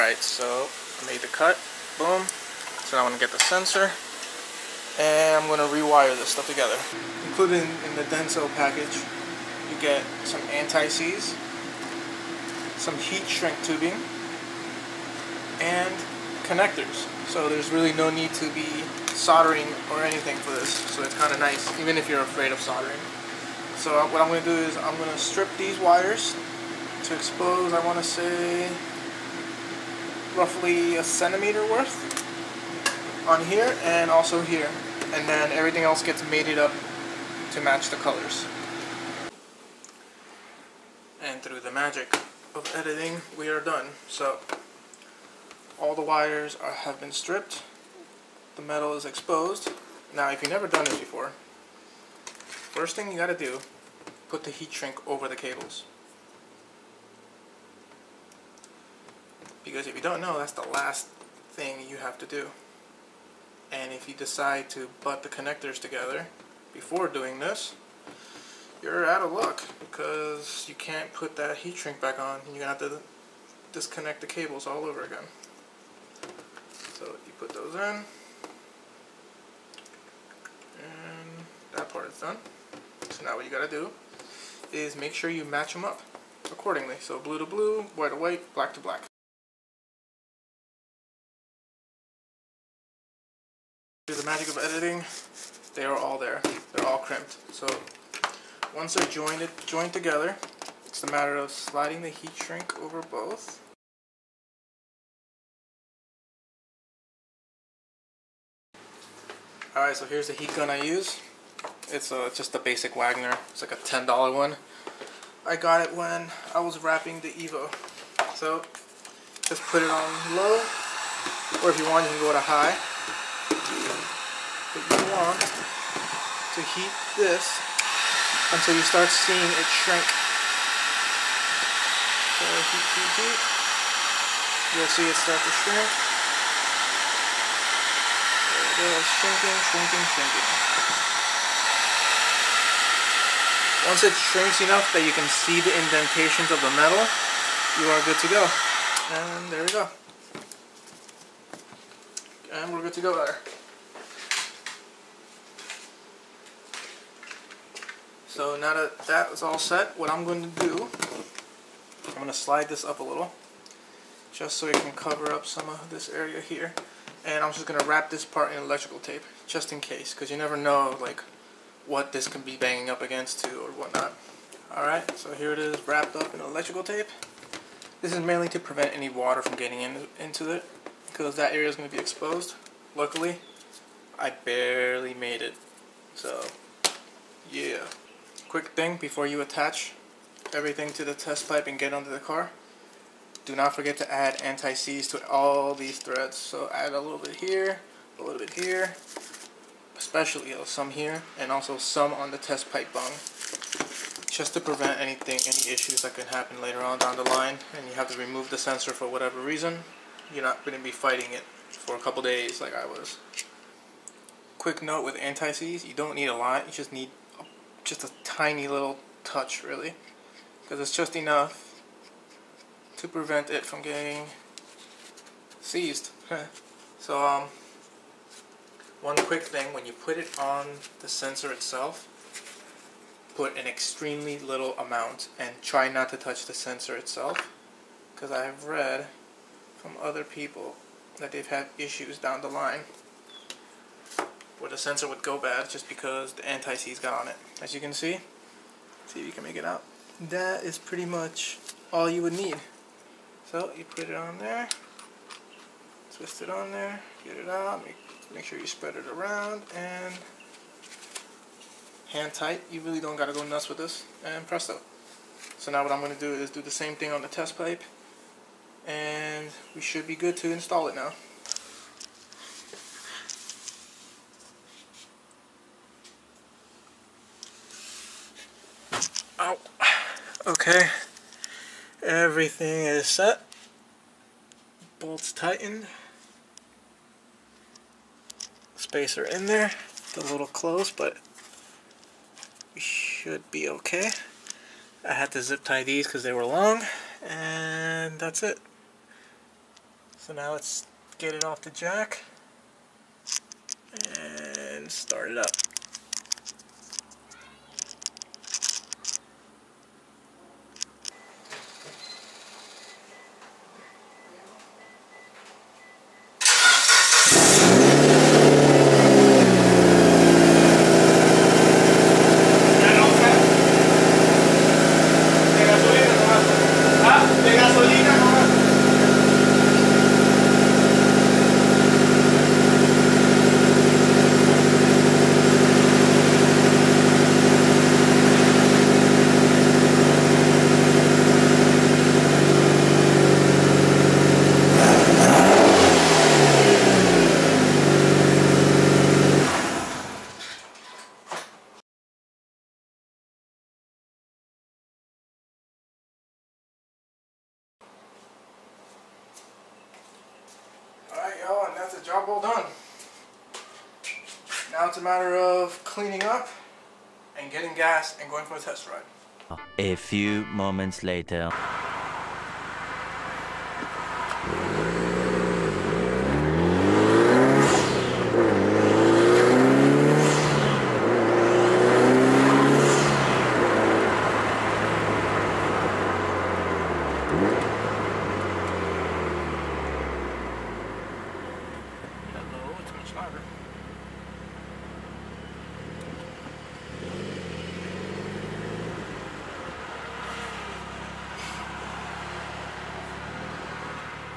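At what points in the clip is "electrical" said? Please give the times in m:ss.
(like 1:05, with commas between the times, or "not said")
2:48, 2:56.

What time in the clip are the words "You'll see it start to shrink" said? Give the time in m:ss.
2:14.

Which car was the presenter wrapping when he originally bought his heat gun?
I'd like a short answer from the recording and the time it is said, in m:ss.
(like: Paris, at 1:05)
the Evo, at 1:57.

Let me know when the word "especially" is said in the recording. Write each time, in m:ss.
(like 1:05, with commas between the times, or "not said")
3:19.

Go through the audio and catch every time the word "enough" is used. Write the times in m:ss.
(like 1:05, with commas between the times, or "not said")
2:24, 3:41.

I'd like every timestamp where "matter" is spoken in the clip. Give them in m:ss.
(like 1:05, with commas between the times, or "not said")
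1:41, 6:05.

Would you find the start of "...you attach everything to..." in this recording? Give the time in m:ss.
3:09.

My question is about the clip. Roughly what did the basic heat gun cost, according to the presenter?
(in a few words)
$10.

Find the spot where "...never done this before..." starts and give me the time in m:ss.
0:50.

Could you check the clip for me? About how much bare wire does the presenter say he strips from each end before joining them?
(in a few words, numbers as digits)
a centimeter.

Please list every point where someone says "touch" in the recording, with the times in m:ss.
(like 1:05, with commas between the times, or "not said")
3:39, 3:56.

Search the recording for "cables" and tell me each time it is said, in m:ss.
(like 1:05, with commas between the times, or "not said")
0:55, 1:14.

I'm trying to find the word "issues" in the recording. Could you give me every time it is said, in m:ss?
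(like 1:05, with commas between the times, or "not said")
3:25, 4:01.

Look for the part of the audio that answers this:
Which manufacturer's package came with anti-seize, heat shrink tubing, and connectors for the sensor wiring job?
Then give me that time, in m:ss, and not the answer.
0:08.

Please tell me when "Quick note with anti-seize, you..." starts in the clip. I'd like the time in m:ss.
3:34.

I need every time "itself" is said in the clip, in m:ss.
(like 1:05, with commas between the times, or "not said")
3:51, 3:56.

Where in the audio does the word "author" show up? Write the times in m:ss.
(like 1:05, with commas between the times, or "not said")
not said.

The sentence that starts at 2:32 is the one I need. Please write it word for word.
And we're good to go there.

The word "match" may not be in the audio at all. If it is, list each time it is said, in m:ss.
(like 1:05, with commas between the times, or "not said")
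0:37, 1:25.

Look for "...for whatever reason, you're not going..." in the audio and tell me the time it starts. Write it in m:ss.
3:28.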